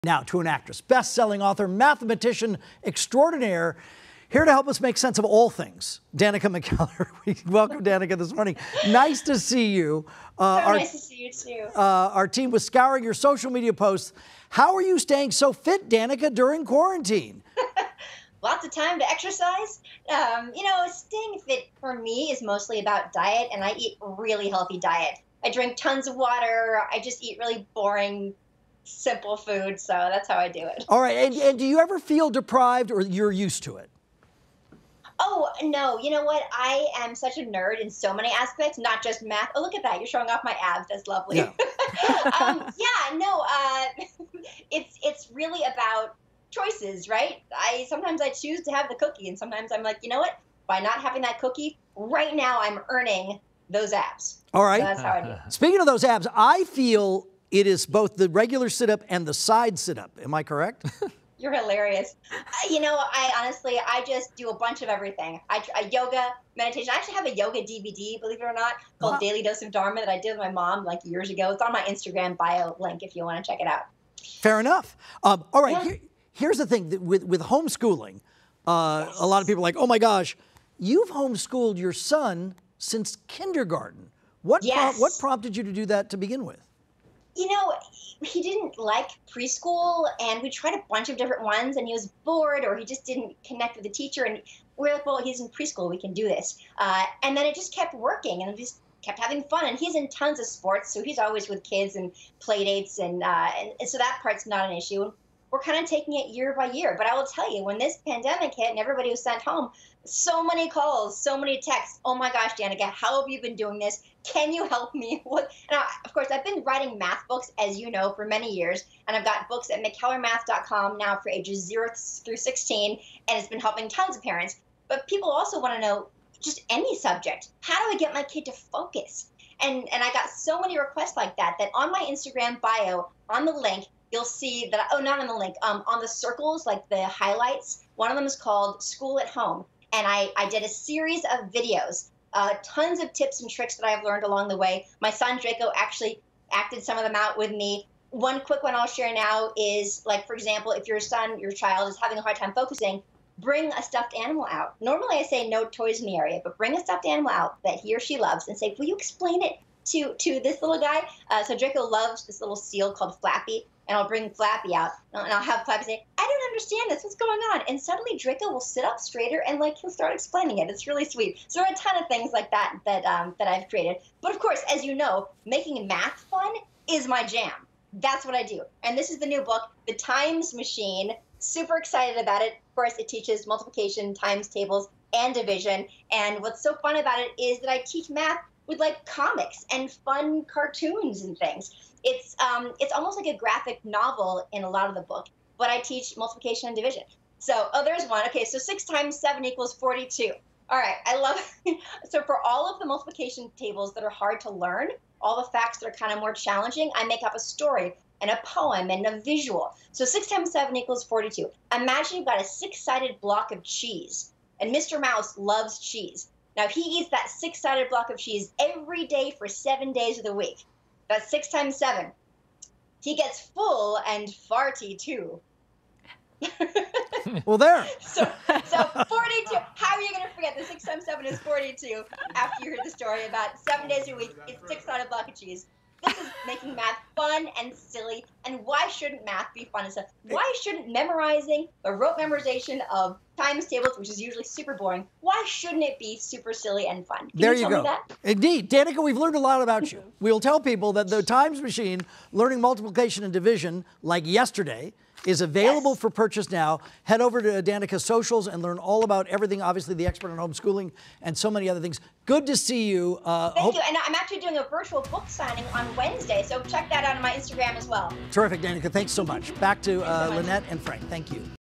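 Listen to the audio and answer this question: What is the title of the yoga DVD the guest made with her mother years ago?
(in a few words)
Daily Dose of Dharma.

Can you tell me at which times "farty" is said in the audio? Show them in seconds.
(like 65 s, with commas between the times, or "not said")
224 s.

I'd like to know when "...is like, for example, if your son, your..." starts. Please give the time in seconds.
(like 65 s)
149 s.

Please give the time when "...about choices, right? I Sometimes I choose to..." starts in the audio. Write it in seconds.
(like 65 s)
45 s.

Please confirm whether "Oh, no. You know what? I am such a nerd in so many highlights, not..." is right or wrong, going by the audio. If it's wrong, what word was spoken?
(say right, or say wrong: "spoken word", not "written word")
wrong: "aspects", not "highlights".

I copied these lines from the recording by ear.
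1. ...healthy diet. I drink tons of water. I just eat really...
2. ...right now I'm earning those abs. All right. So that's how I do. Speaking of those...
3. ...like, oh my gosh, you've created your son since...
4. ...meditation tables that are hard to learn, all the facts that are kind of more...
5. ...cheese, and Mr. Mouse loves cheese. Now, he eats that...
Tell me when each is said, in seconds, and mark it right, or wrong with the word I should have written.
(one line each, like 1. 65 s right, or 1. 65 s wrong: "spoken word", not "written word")
1. 24 s right
2. 51 s right
3. 79 s wrong: "homeschooled", not "created"
4. 202 s wrong: "multiplication", not "meditation"
5. 213 s right.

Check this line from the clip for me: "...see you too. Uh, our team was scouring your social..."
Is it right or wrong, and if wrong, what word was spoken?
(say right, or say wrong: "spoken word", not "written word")
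right.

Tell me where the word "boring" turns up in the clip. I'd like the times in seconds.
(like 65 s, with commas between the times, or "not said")
27 s, 244 s.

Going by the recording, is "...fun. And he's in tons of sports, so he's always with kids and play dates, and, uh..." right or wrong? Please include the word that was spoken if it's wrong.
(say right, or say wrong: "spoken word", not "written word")
right.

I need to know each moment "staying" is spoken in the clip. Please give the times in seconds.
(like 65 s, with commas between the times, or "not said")
14 s, 20 s.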